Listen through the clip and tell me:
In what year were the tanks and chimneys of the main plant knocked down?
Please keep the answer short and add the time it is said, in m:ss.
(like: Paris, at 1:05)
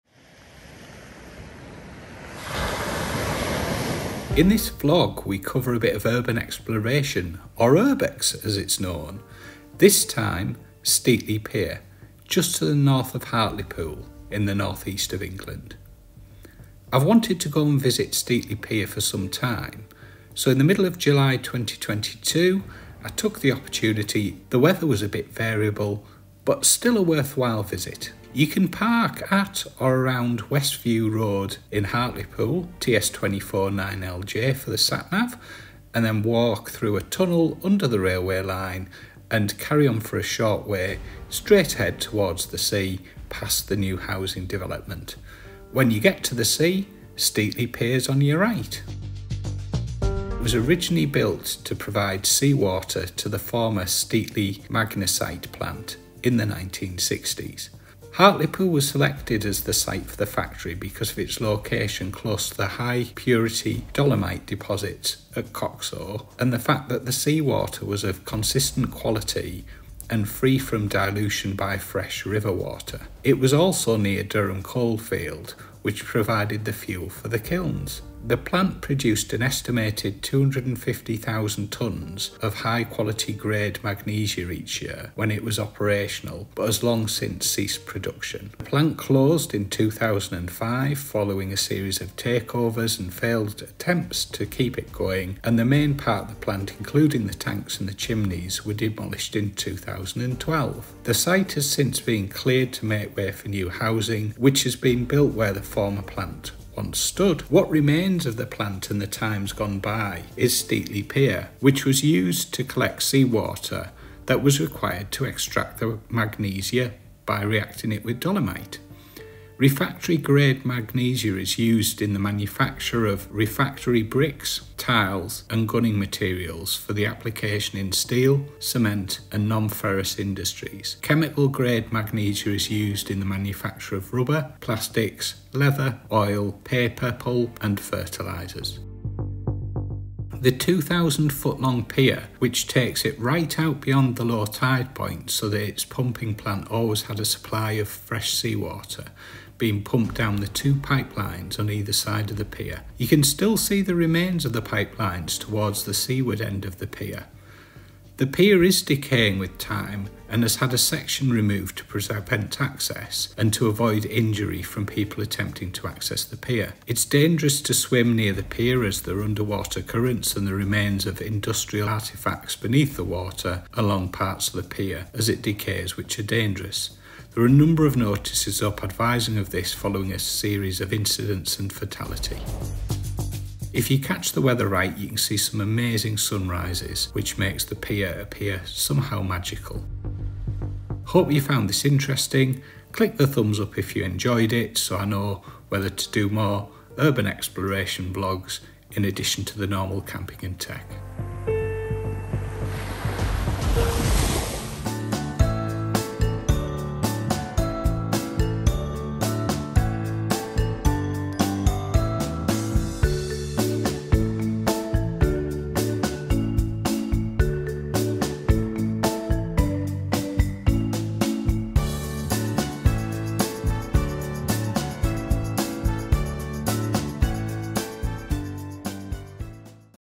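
2012, at 1:39.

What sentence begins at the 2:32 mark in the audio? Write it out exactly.
You can still see the remains of the pipelines towards the seaward end of the pier.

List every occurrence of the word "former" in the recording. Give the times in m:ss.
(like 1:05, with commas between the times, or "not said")
0:53, 1:45.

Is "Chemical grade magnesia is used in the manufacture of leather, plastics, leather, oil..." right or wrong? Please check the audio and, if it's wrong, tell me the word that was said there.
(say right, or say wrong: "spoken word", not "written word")
wrong: "rubber", not "leather".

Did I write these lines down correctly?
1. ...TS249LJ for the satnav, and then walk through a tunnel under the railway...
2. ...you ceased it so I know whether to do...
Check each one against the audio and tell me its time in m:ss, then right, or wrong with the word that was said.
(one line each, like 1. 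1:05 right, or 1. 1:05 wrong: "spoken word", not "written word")
1. 0:32 right
2. 3:13 wrong: "enjoyed", not "ceased".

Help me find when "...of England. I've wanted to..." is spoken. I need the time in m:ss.
0:15.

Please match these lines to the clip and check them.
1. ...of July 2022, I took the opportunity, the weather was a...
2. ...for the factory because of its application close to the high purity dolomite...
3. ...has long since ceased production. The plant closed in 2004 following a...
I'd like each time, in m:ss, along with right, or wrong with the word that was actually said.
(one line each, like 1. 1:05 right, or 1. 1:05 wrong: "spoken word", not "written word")
1. 0:20 right
2. 1:00 wrong: "location", not "application"
3. 1:26 wrong: "2005", not "2004".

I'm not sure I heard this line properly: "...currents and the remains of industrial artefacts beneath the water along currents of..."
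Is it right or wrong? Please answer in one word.
wrong.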